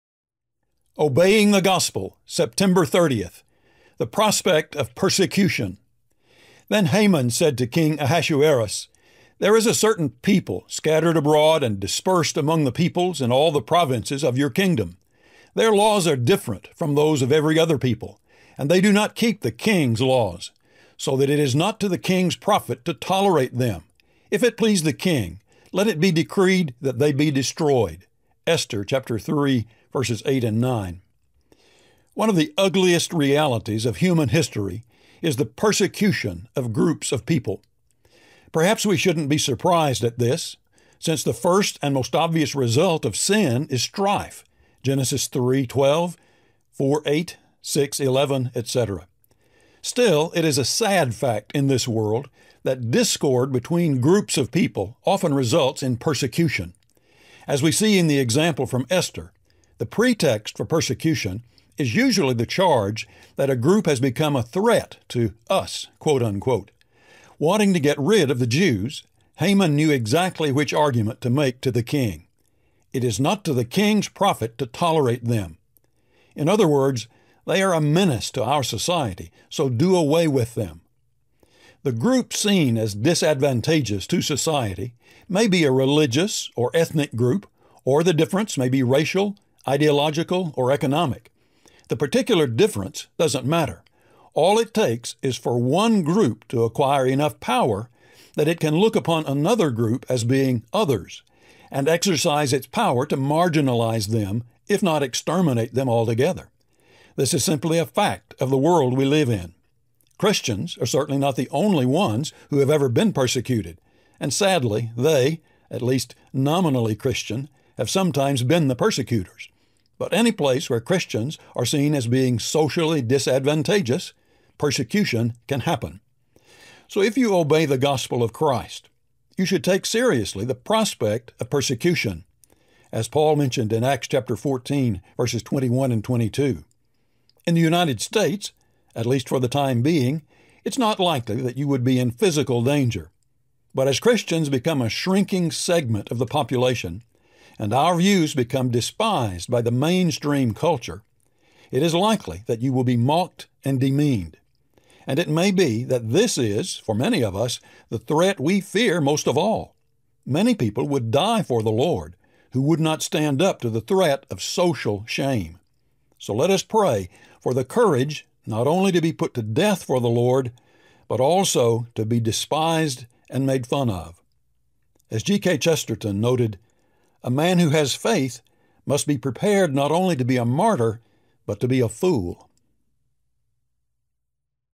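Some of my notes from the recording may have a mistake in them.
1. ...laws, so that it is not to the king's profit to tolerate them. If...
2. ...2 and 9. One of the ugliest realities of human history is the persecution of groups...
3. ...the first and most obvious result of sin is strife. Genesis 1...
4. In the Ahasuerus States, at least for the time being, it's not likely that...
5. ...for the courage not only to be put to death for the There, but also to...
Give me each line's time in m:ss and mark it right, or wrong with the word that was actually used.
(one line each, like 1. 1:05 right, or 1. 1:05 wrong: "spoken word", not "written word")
1. 0:20 right
2. 0:30 wrong: "8", not "2"
3. 0:41 wrong: "3", not "1"
4. 2:17 wrong: "United", not "Ahasuerus"
5. 2:47 wrong: "Lord", not "There".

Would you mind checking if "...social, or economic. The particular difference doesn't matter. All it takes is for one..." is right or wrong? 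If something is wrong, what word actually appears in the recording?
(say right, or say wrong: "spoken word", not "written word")
wrong: "ideological", not "social".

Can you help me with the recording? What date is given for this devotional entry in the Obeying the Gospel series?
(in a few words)
September 30th.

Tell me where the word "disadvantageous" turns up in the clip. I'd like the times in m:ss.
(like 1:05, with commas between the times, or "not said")
1:22, 2:03.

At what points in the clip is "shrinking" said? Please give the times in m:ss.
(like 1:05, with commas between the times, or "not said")
2:24.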